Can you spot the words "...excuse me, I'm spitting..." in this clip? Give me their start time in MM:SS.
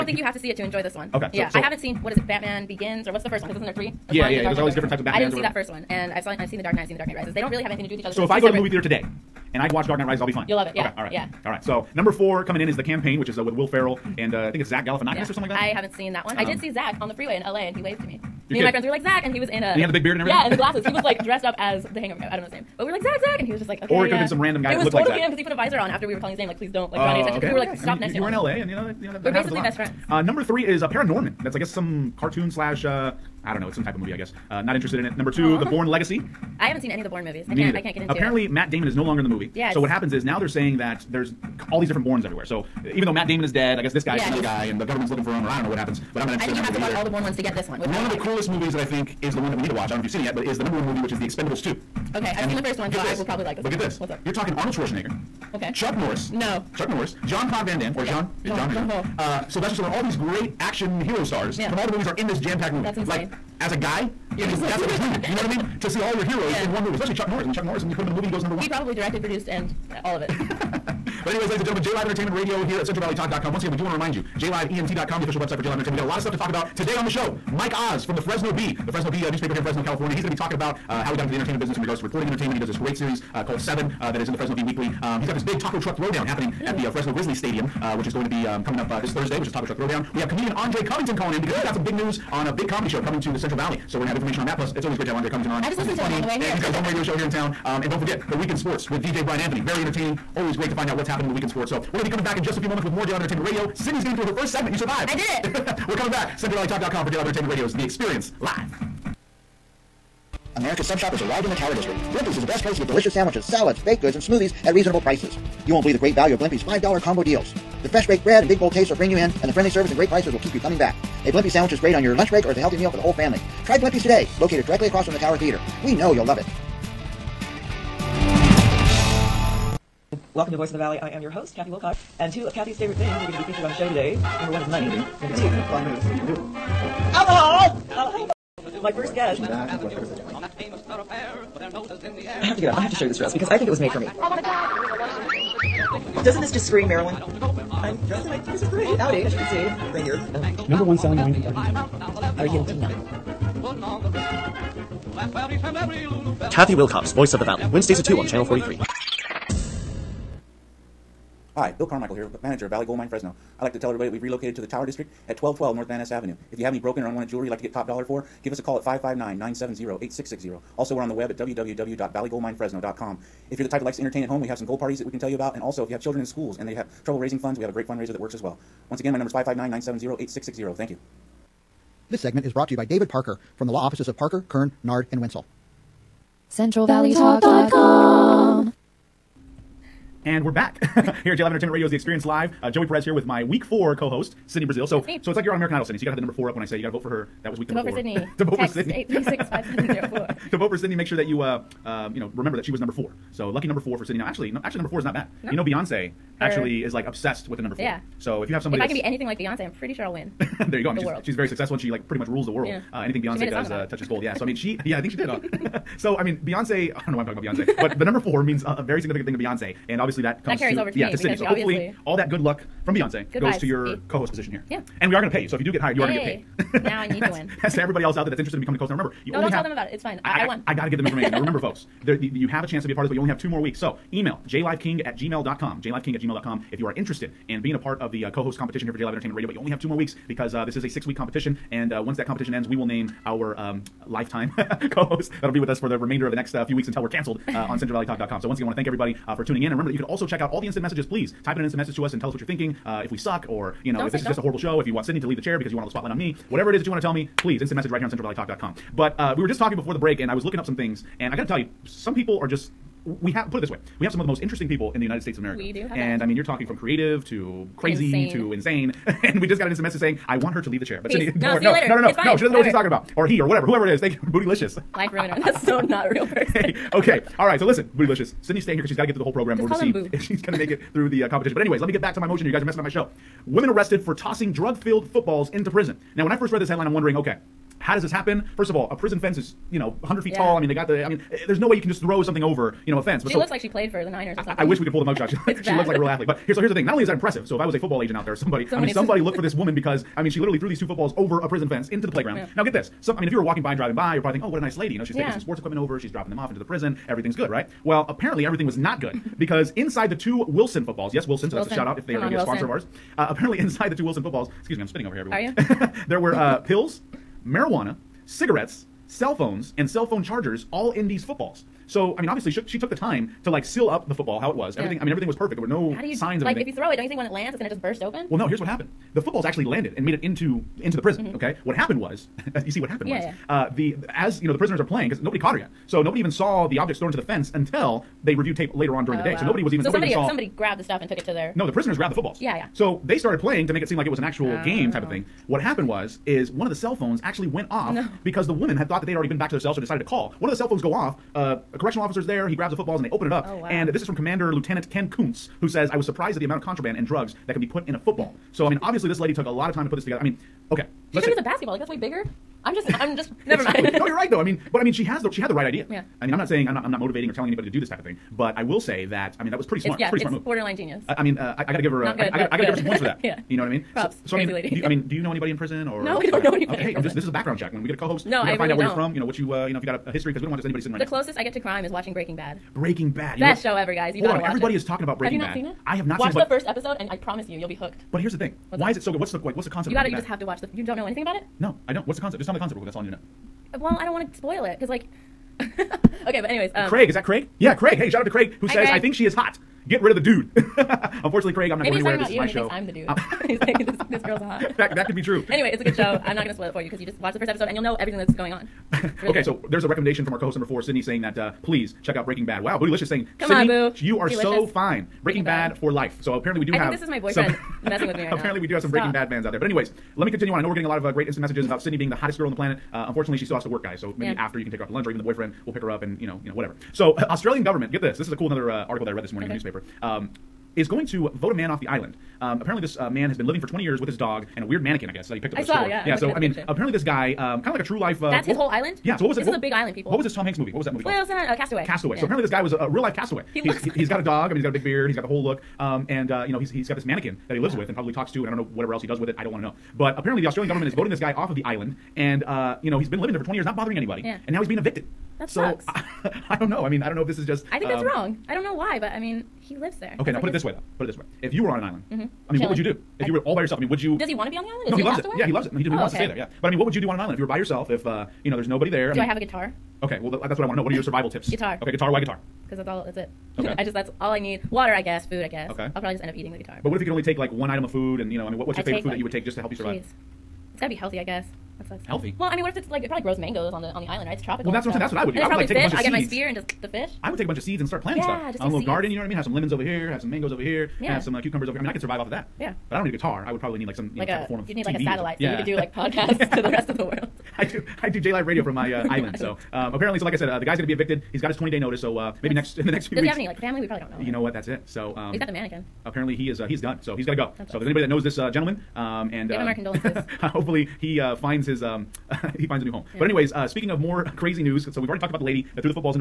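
05:14.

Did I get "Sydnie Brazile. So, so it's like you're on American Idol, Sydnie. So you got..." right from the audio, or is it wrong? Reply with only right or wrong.
right.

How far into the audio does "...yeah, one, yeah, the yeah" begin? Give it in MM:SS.
00:04.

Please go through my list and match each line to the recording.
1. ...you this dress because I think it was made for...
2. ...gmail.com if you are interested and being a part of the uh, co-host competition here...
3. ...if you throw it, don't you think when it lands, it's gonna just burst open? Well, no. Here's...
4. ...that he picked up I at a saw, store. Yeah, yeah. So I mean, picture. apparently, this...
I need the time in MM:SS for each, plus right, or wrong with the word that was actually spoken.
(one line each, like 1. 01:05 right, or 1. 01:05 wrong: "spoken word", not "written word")
1. 02:23 right
2. 03:56 right
3. 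05:26 right
4. 07:15 right.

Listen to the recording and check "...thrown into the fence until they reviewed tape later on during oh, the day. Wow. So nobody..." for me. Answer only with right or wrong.
right.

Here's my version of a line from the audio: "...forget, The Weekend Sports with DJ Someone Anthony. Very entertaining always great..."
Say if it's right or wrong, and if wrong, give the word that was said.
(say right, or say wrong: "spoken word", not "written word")
wrong: "Brian", not "Someone".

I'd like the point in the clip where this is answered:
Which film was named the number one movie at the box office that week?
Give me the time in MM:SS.
00:51.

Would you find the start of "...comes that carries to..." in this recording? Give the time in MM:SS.
03:40.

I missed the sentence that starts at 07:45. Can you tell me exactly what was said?
No, he, do, he oh, wants okay.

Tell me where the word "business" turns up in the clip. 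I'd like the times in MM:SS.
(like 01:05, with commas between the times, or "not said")
01:21.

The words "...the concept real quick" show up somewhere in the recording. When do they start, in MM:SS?
06:32.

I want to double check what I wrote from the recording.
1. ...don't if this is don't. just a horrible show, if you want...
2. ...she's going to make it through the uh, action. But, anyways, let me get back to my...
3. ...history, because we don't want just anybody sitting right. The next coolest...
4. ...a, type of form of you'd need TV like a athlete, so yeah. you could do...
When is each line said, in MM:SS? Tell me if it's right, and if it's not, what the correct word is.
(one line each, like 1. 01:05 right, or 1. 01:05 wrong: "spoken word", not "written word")
1. 04:13 right
2. 04:40 wrong: "competition", not "action"
3. 06:20 wrong: "closest", not "coolest"
4. 08:14 wrong: "satellite", not "athlete".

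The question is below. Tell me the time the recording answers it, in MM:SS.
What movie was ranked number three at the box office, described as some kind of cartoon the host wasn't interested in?
00:30.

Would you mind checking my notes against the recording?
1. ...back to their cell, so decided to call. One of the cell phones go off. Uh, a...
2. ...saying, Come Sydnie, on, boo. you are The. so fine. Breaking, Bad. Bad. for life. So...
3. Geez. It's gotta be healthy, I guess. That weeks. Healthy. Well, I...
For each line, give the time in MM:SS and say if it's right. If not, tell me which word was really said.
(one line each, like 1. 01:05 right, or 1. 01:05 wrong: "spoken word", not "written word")
1. 05:49 right
2. 06:53 wrong: "Delicious", not "The"
3. 07:59 wrong: "sucks", not "weeks".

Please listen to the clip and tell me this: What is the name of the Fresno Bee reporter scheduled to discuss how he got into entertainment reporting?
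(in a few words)
Mike Oz.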